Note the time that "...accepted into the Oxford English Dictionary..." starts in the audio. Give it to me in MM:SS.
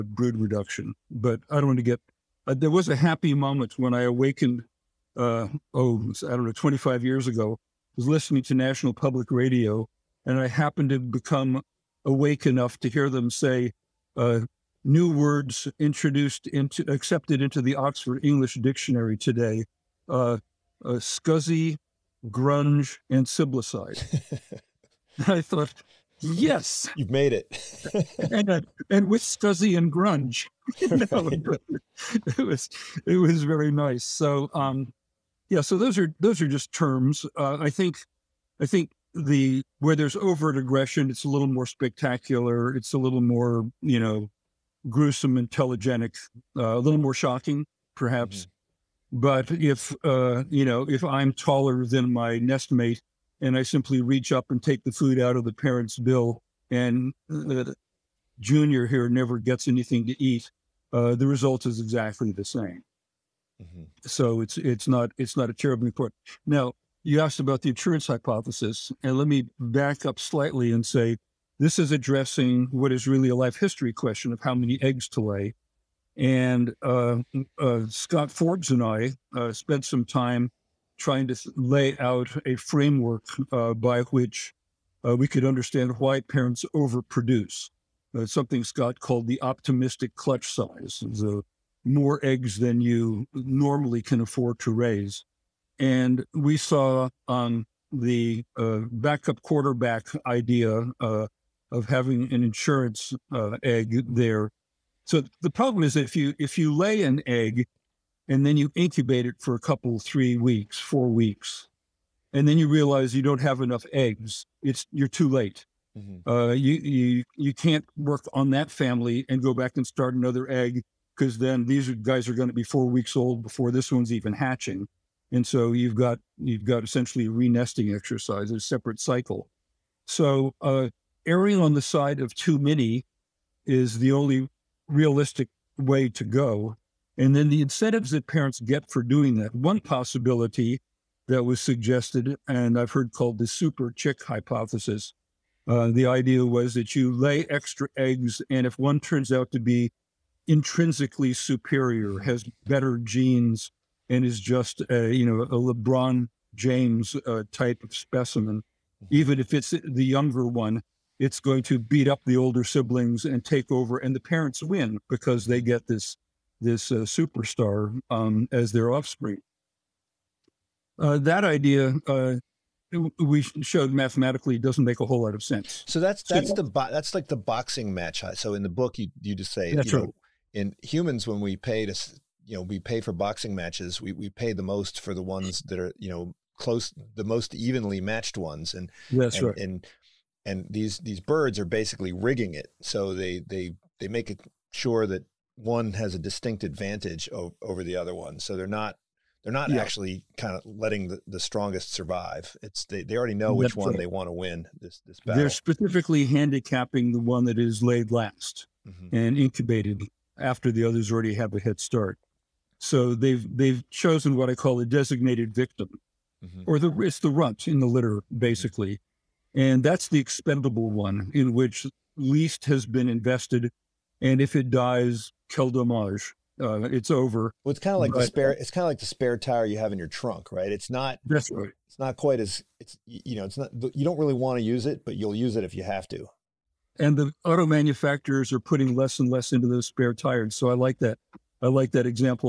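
00:16.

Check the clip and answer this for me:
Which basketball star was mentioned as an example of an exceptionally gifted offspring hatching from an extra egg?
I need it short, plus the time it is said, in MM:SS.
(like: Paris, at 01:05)
LeBron James, at 02:35.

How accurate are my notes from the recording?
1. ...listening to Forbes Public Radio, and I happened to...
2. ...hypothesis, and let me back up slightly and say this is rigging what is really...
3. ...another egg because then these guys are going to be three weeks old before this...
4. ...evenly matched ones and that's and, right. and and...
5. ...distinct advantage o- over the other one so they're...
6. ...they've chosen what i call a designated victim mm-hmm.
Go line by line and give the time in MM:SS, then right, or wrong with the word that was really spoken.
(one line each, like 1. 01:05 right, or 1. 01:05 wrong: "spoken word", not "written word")
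1. 00:08 wrong: "National", not "Forbes"
2. 01:08 wrong: "addressing", not "rigging"
3. 02:00 wrong: "four", not "three"
4. 03:07 right
5. 03:16 right
6. 03:33 right.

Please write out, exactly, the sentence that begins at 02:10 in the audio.
So uh, erring on the side of too many is the only realistic way to go.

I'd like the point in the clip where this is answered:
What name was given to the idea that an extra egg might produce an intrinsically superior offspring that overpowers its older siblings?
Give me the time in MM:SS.
02:23.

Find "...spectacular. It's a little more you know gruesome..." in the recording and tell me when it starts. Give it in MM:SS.
00:41.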